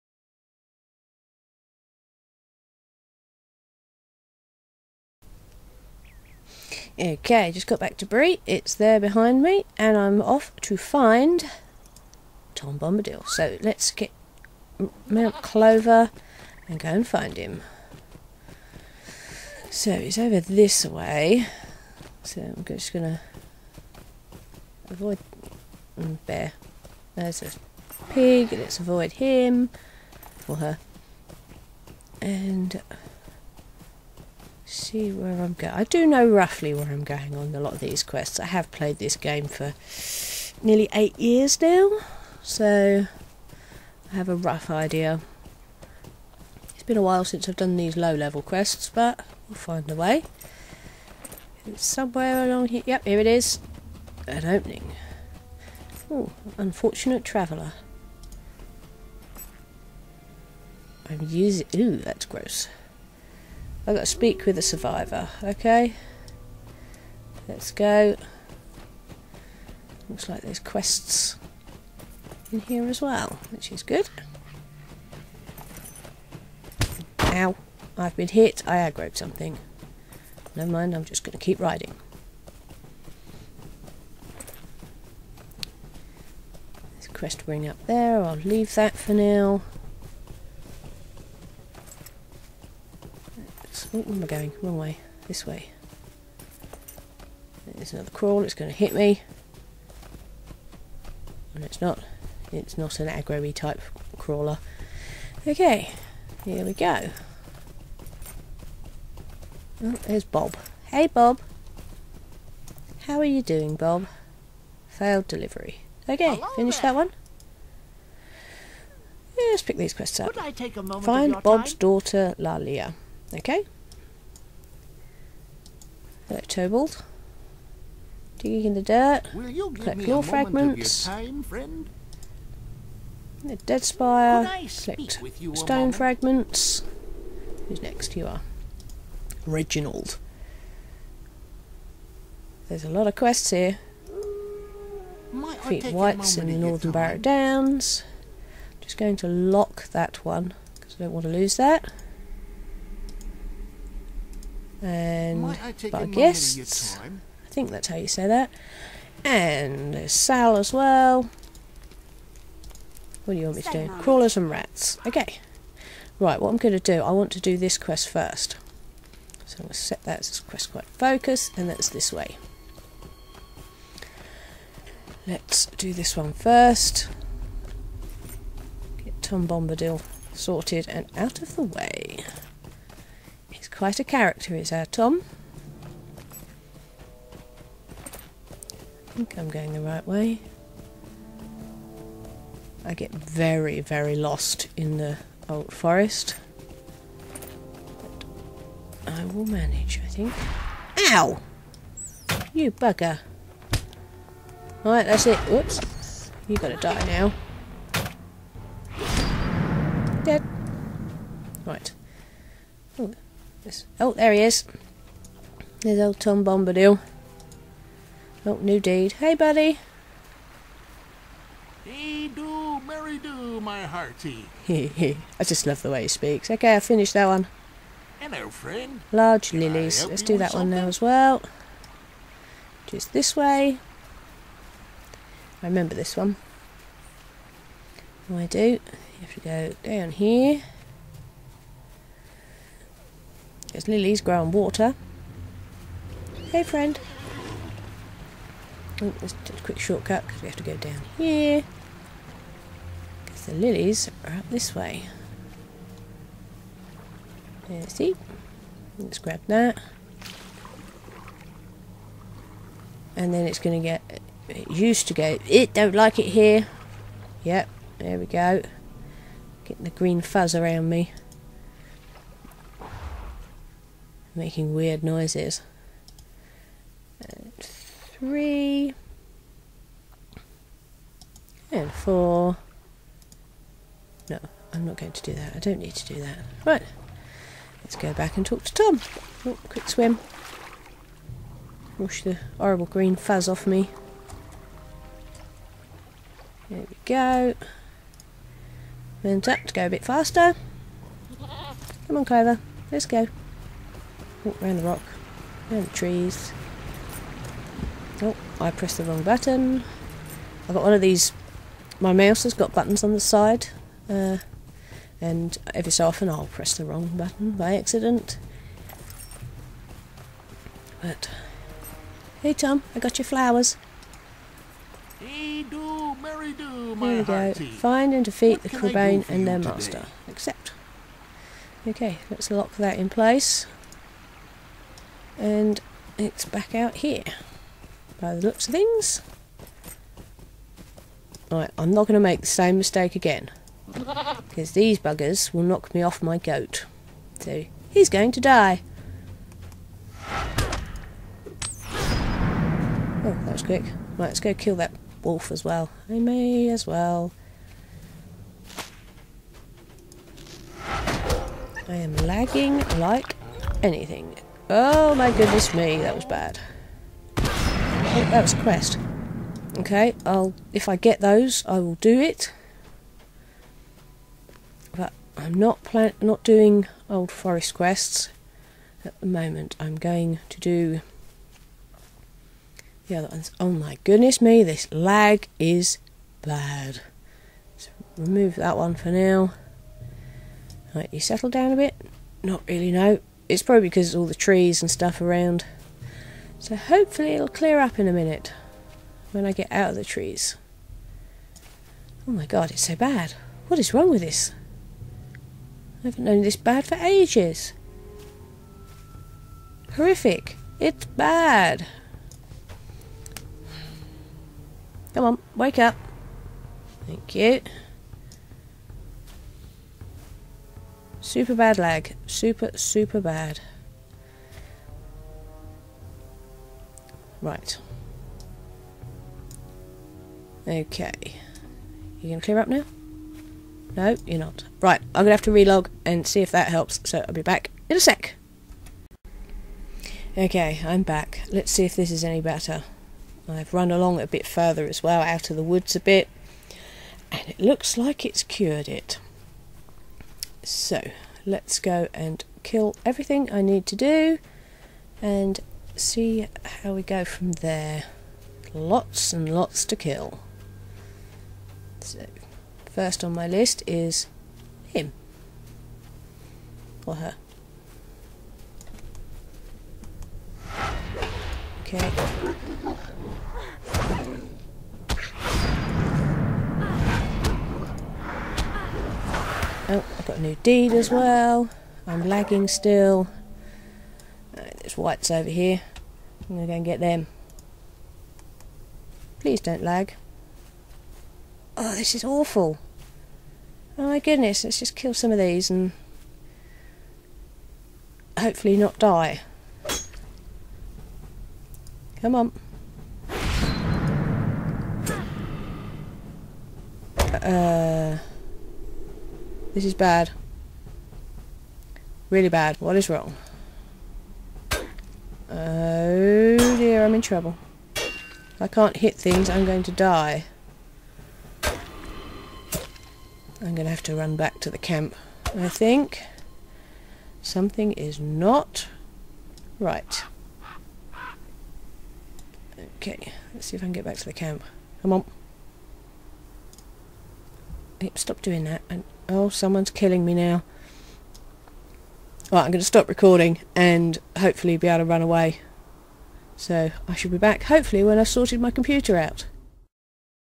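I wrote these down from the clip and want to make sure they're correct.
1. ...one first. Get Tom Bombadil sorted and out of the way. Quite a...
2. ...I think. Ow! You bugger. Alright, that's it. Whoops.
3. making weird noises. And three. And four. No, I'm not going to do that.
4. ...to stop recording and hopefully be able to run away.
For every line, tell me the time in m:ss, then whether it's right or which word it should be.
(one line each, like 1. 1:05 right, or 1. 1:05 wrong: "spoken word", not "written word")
1. 2:56 right
2. 3:20 right
3. 4:34 right
4. 9:02 right.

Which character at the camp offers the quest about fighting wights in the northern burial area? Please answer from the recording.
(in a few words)
Reginald.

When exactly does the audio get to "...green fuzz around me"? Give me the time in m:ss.
4:29.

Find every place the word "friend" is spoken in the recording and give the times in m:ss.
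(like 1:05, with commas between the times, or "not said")
3:48, 4:06.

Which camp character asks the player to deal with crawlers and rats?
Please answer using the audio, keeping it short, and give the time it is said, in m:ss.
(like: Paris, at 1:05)
Sal, at 2:40.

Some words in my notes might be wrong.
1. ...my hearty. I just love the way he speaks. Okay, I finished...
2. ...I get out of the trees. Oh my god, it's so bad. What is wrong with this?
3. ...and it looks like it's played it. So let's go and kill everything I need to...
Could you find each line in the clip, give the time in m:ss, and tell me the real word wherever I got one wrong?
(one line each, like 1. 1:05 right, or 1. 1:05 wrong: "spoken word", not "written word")
1. 3:43 right
2. 6:39 right
3. 7:27 wrong: "cured", not "played".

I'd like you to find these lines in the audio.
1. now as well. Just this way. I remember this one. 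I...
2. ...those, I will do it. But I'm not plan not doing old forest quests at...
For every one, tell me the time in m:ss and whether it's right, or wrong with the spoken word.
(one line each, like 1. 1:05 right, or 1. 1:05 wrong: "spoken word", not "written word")
1. 3:50 right
2. 6:11 right.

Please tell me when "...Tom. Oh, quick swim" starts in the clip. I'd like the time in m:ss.
4:48.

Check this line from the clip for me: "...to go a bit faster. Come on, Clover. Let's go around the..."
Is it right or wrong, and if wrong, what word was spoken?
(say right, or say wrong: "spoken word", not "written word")
right.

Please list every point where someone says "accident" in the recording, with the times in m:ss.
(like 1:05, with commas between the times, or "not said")
5:17.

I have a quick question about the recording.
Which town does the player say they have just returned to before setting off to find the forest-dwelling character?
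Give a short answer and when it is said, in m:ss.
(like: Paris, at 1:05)
Bree, at 0:08.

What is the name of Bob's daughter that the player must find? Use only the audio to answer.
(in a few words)
Lalia.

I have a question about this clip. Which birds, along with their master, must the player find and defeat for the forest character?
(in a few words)
Crebain.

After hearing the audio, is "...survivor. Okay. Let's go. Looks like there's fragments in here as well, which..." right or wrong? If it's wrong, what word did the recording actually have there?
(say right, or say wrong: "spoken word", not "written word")
wrong: "quests", not "fragments".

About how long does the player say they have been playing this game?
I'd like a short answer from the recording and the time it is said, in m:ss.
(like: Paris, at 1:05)
nearly 8 years, at 0:40.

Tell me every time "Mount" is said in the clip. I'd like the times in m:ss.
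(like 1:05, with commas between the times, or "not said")
0:15.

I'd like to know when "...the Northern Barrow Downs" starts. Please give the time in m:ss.
2:26.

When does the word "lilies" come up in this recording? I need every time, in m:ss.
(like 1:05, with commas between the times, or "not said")
3:49, 4:03, 4:13.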